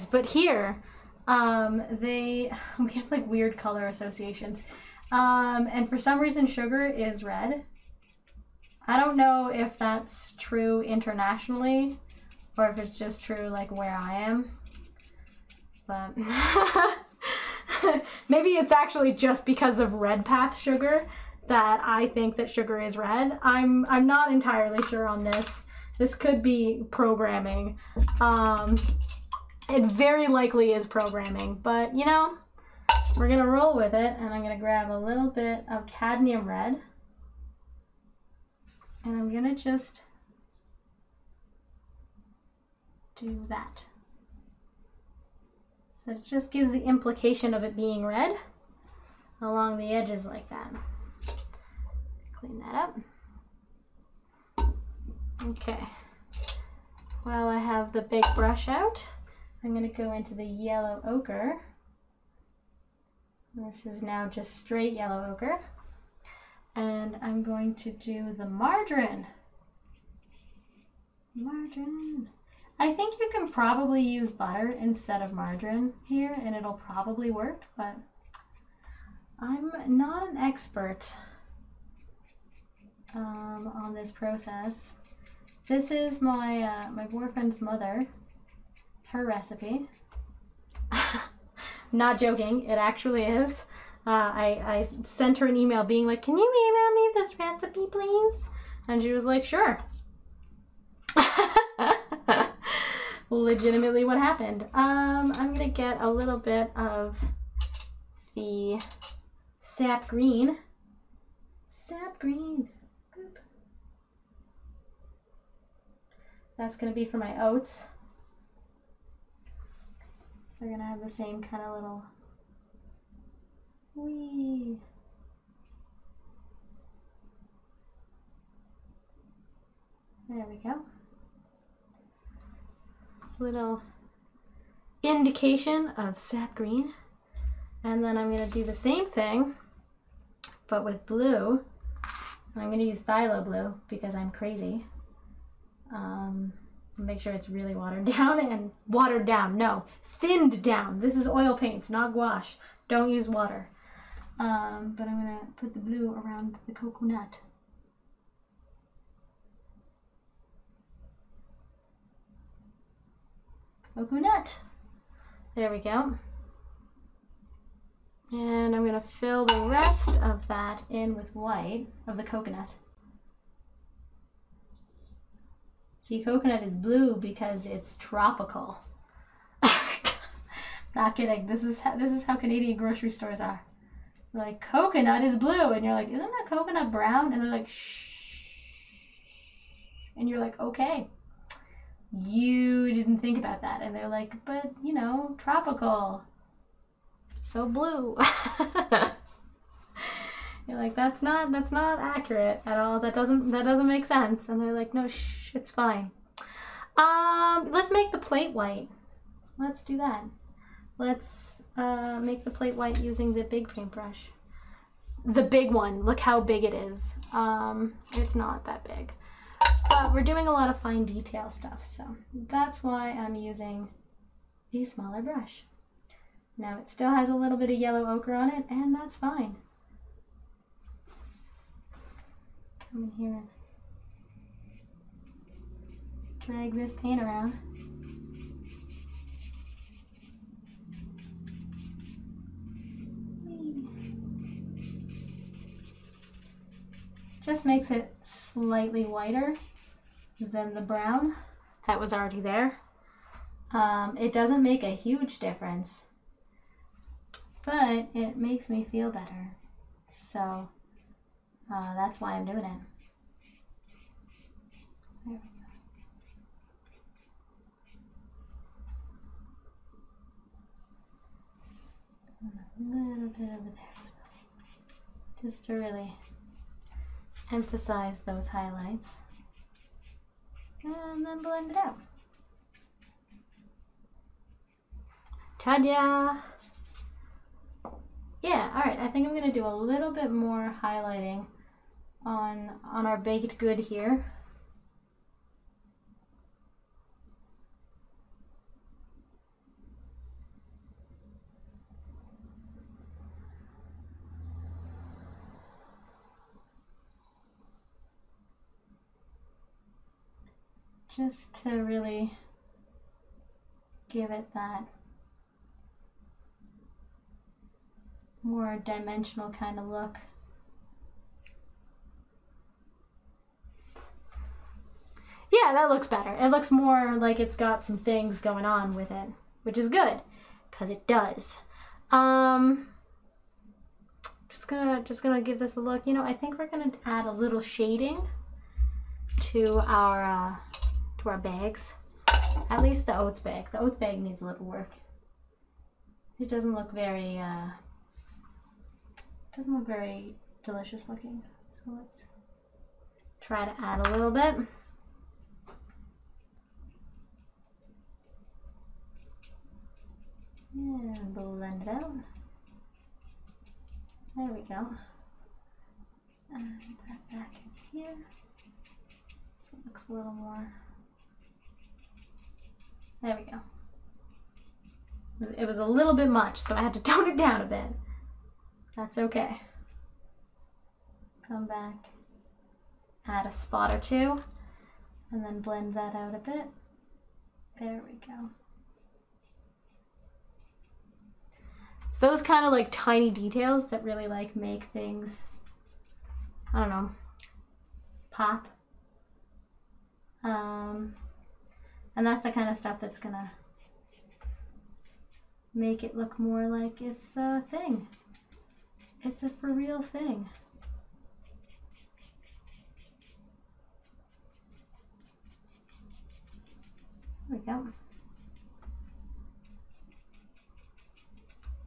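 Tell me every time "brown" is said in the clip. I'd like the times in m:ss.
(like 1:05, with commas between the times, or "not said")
3:06, 4:10.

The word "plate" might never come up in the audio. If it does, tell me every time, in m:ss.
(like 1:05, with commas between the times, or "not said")
3:28, 3:32.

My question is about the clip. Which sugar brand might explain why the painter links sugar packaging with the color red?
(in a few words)
Redpath.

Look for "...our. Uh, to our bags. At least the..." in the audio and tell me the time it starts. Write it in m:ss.
5:39.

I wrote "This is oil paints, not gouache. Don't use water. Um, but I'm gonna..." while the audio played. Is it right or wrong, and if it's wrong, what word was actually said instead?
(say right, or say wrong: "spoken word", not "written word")
right.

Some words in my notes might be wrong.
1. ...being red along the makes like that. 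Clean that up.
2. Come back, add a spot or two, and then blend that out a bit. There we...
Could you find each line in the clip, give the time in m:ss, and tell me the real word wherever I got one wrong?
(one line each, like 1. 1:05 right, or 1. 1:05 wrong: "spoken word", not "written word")
1. 0:47 wrong: "edges", not "makes"
2. 6:21 right.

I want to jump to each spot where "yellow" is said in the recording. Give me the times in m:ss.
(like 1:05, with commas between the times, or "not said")
1:00, 1:04, 3:47.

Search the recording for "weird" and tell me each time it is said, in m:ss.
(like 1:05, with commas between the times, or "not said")
0:03.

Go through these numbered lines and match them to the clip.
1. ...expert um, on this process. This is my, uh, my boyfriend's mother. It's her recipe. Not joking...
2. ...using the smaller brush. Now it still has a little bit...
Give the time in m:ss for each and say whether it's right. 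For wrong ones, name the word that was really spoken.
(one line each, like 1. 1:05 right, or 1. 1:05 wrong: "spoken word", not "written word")
1. 1:20 right
2. 3:43 right.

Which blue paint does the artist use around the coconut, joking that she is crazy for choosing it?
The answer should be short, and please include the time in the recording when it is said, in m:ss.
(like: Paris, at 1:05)
Phthalo blue, at 2:23.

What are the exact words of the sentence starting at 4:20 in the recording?
So uh, that's why I'm doing it.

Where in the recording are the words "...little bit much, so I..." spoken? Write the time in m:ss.
6:15.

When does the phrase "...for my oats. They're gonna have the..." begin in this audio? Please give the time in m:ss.
1:57.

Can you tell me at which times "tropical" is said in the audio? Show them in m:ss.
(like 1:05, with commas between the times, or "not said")
2:57, 3:15.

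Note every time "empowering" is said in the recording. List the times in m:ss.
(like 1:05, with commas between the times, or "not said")
not said.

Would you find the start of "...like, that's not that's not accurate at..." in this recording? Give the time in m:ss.
3:20.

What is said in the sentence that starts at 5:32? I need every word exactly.
Um, just gonna just gonna give this a look.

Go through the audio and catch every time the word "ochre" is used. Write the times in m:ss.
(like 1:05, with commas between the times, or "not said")
1:01, 1:05, 3:48.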